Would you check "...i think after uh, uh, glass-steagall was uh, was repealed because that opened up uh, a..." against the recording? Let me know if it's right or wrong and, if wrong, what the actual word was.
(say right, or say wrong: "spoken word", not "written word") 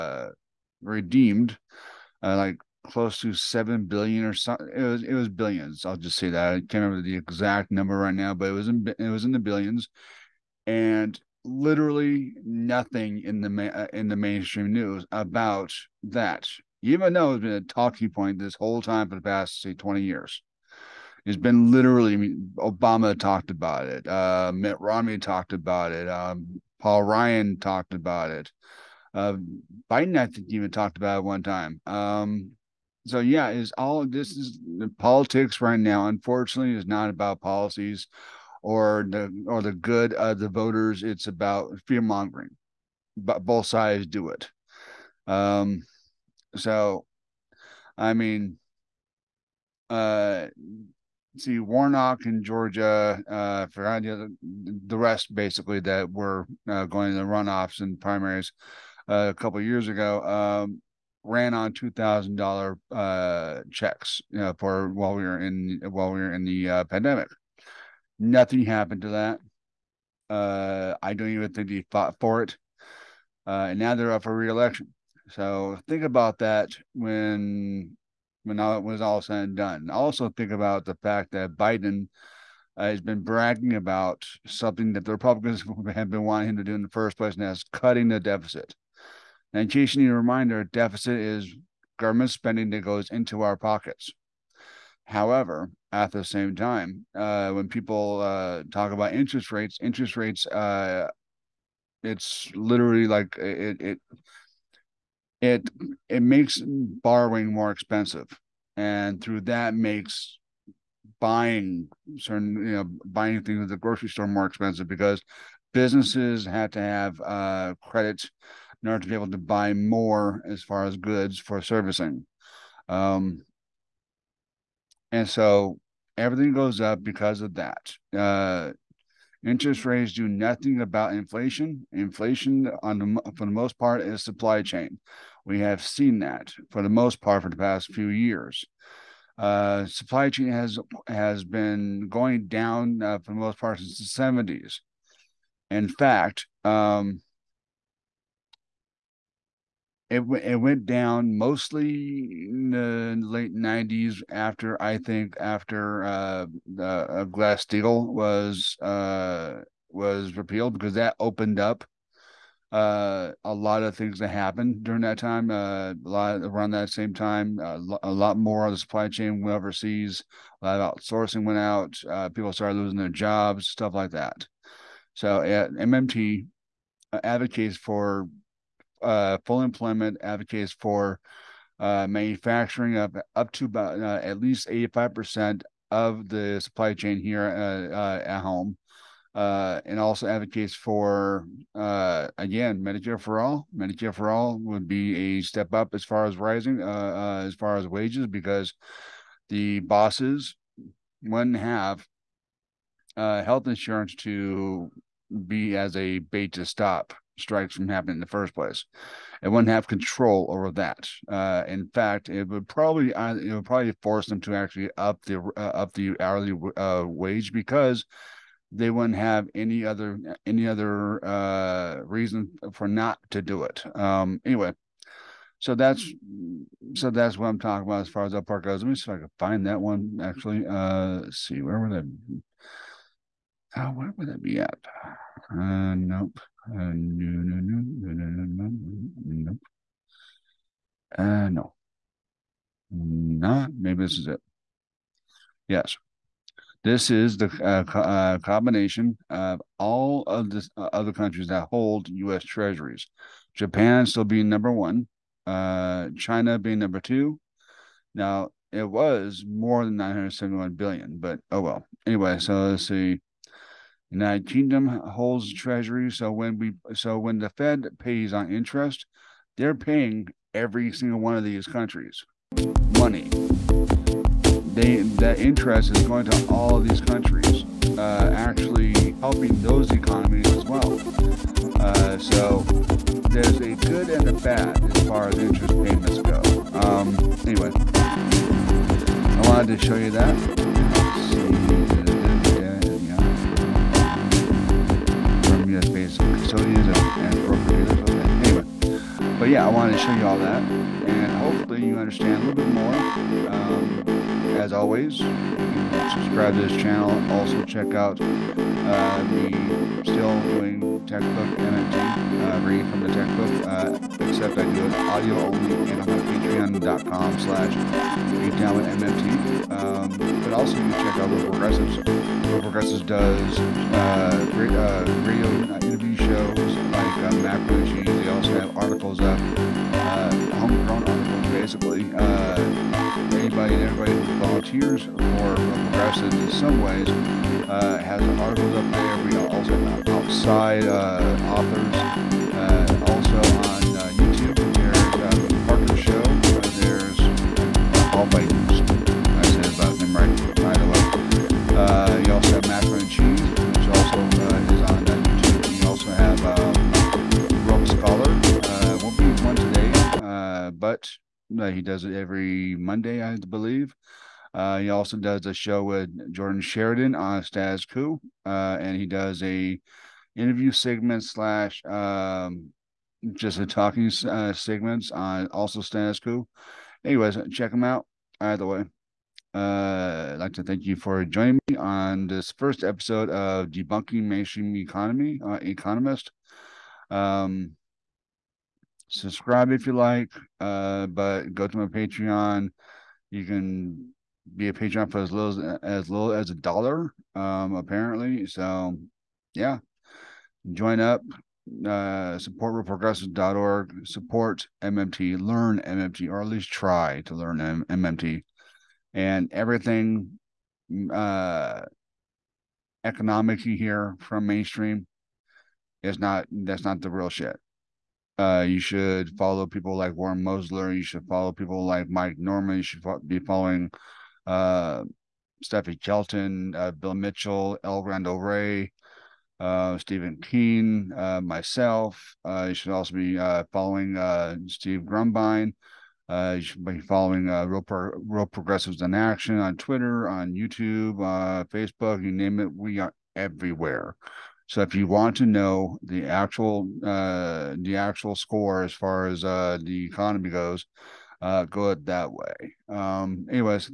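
right.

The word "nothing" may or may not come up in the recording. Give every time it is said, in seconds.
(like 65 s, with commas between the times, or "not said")
12 s, 68 s, 130 s.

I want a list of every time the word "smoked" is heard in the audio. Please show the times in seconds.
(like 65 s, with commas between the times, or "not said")
not said.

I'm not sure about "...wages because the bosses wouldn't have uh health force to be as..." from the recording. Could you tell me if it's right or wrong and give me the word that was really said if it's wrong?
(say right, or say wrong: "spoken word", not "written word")
wrong: "insurance", not "force".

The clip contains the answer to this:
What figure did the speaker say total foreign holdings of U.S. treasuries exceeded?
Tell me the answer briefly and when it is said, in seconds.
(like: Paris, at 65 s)
971 billion, at 259 s.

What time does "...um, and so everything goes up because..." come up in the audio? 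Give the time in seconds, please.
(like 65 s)
122 s.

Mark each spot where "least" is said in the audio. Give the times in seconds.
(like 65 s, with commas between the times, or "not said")
184 s, 406 s.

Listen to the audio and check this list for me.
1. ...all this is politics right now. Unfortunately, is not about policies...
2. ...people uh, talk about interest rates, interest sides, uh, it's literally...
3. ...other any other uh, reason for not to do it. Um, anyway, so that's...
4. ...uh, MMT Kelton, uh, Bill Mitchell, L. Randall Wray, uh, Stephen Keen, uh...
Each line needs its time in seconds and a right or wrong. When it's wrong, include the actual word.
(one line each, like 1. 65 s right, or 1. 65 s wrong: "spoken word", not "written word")
1. 33 s right
2. 97 s wrong: "rates", not "sides"
3. 219 s right
4. 424 s wrong: "Steffi", not "MMT".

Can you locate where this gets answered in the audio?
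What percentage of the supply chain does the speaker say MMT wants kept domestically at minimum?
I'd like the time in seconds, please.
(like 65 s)
184 s.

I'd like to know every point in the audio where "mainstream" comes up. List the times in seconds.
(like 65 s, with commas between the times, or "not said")
14 s, 384 s, 414 s.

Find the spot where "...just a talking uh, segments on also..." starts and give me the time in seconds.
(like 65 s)
373 s.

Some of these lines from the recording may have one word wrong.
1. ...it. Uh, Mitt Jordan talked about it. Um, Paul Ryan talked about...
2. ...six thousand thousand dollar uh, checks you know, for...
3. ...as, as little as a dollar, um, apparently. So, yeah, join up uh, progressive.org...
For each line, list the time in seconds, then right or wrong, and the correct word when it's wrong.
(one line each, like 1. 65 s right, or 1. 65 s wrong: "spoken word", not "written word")
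1. 23 s wrong: "Romney", not "Jordan"
2. 61 s wrong: "two", not "six"
3. 395 s right.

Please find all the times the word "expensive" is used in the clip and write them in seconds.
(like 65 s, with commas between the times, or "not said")
107 s, 114 s.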